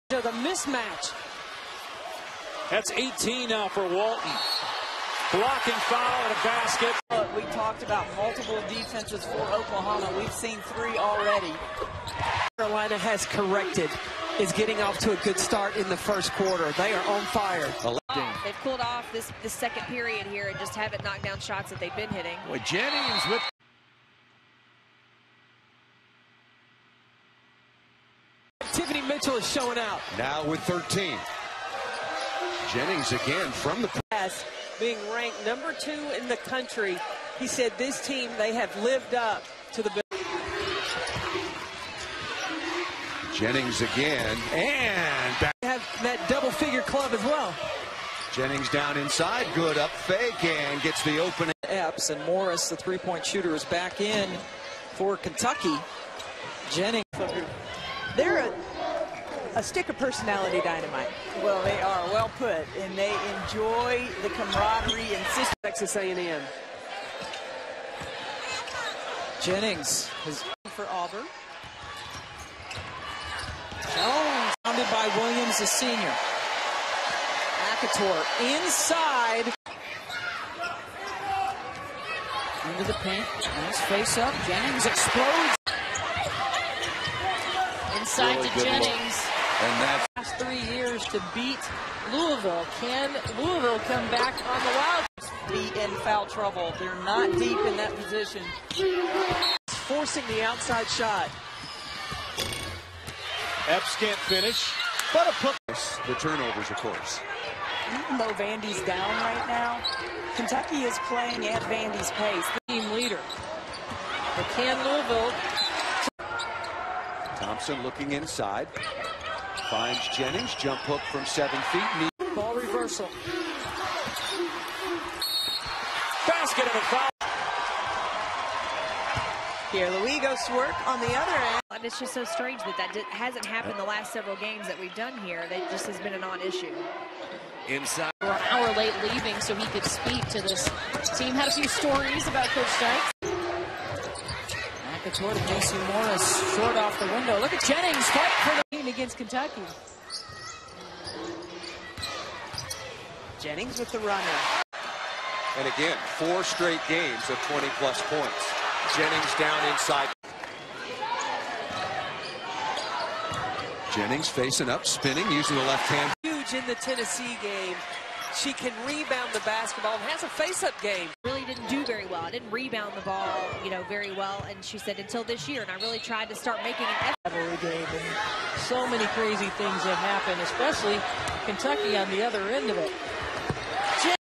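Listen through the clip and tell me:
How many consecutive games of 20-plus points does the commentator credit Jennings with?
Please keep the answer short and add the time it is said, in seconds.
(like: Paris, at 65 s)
4, at 156 s.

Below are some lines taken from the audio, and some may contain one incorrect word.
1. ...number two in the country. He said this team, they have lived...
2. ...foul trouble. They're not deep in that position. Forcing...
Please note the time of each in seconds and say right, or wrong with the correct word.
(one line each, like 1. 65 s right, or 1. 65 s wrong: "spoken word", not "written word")
1. 35 s right
2. 96 s right.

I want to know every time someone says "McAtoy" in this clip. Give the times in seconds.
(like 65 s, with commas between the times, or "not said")
144 s.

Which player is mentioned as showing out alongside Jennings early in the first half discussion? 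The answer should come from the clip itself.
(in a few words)
Tiffany Mitchell.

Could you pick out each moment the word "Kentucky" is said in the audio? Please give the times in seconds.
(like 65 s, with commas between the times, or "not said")
55 s, 110 s, 149 s, 181 s.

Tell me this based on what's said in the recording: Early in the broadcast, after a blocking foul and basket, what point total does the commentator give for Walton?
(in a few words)
18.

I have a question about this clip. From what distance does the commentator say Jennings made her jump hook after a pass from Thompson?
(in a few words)
7 feet.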